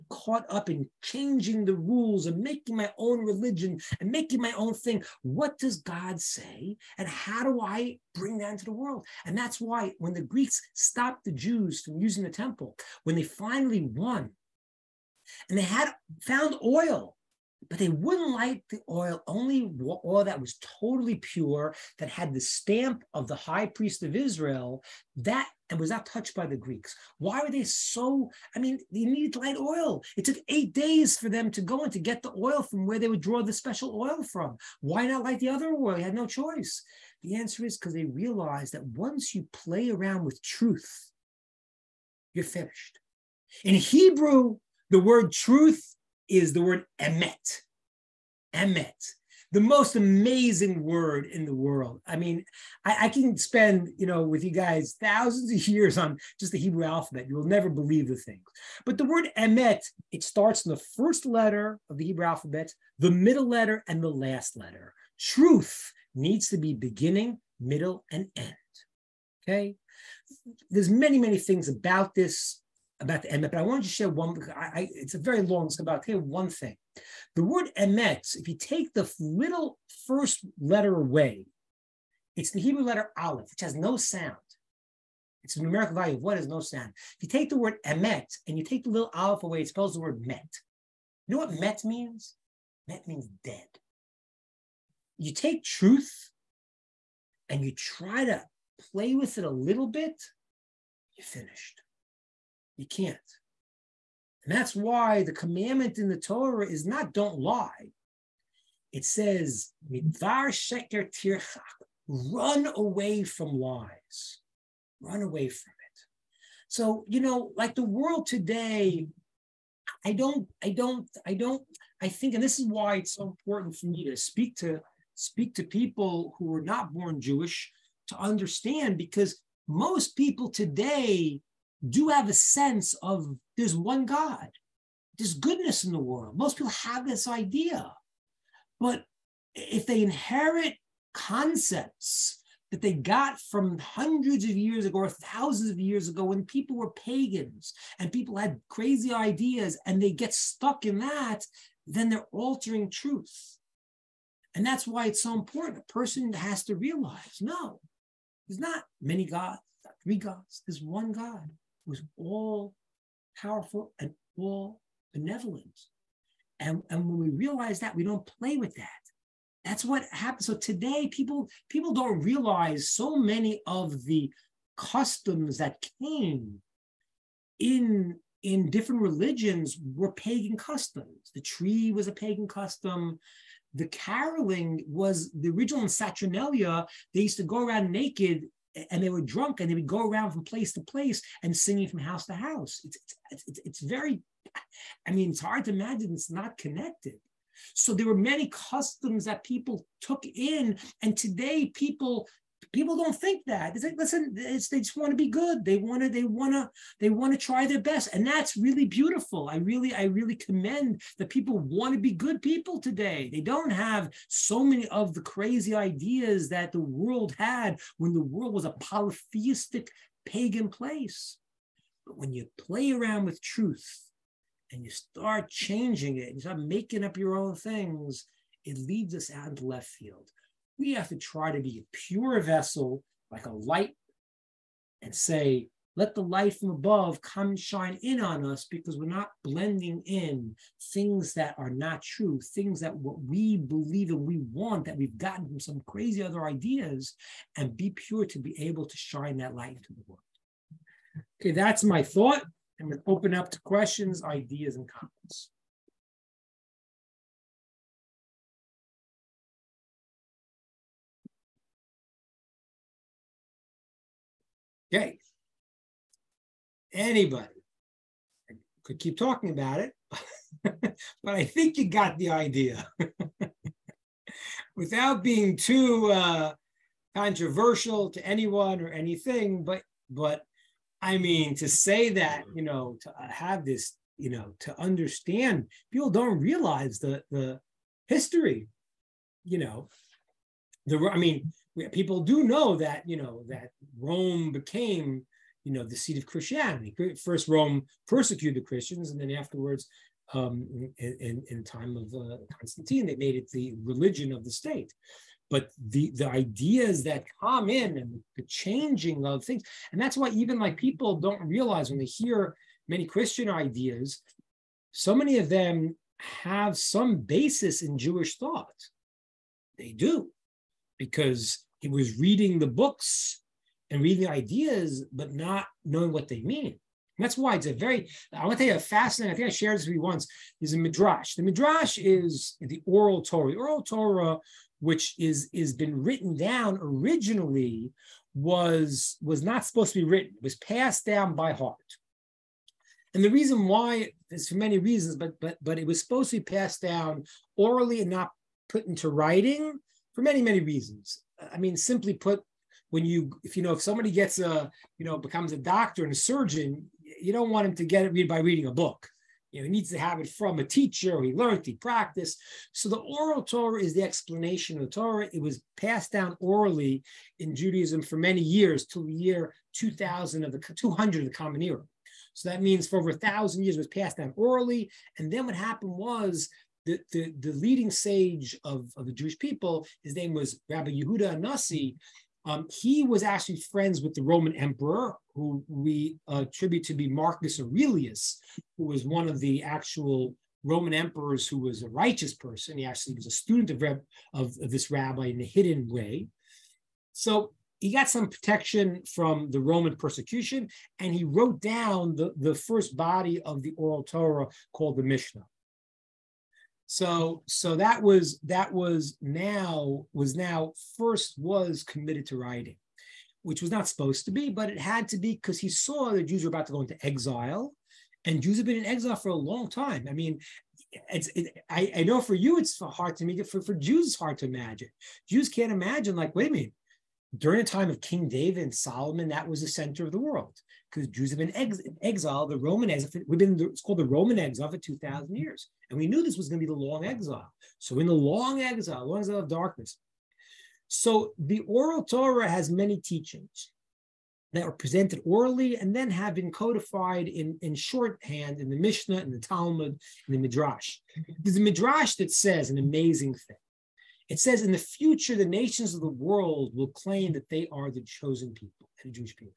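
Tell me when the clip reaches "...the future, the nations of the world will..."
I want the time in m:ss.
7:34.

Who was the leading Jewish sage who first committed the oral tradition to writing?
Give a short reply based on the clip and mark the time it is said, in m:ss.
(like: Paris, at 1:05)
Rabbi Yehuda HaNasi, at 6:20.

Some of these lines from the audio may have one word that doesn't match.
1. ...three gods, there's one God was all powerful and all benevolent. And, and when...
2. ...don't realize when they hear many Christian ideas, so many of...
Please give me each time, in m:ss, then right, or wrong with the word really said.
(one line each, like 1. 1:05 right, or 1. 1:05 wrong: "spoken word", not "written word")
1. 2:40 right
2. 5:11 right.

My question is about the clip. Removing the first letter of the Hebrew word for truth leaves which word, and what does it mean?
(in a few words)
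Dead.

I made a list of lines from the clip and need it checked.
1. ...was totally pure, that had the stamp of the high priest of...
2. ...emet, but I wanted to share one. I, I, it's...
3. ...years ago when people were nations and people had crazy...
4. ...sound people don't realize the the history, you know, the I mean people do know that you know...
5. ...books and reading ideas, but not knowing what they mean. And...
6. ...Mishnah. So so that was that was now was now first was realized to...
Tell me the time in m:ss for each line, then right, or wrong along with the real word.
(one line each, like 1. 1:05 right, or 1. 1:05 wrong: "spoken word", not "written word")
1. 0:20 right
2. 1:13 right
3. 2:25 wrong: "pagans", not "nations"
4. 4:44 wrong: "understand", not "sound"
5. 5:22 right
6. 6:45 wrong: "committed", not "realized".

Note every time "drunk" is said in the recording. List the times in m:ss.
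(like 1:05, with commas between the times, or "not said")
3:09.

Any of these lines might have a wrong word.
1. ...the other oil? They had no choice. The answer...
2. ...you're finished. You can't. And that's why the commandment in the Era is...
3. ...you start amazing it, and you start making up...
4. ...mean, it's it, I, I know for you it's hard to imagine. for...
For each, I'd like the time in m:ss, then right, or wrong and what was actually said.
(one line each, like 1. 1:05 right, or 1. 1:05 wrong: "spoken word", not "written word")
1. 0:35 right
2. 1:41 wrong: "Torah", not "Era"
3. 3:44 wrong: "changing", not "amazing"
4. 7:00 right.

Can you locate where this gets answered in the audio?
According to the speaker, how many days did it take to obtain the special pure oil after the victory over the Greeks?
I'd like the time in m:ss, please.
0:30.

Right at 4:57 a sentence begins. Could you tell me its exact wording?
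First, Rome persecuted Christians, and then afterwards, um, in, in time of uh, Constantine, they made it the religion of the state.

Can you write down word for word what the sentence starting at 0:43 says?
In Hebrew, the word truth is the word emet.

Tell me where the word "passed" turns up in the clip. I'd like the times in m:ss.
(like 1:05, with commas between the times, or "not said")
5:40, 5:46, 6:05, 6:13.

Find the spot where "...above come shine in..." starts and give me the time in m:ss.
3:56.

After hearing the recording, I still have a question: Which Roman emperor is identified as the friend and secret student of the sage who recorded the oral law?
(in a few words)
Marcus Aurelius.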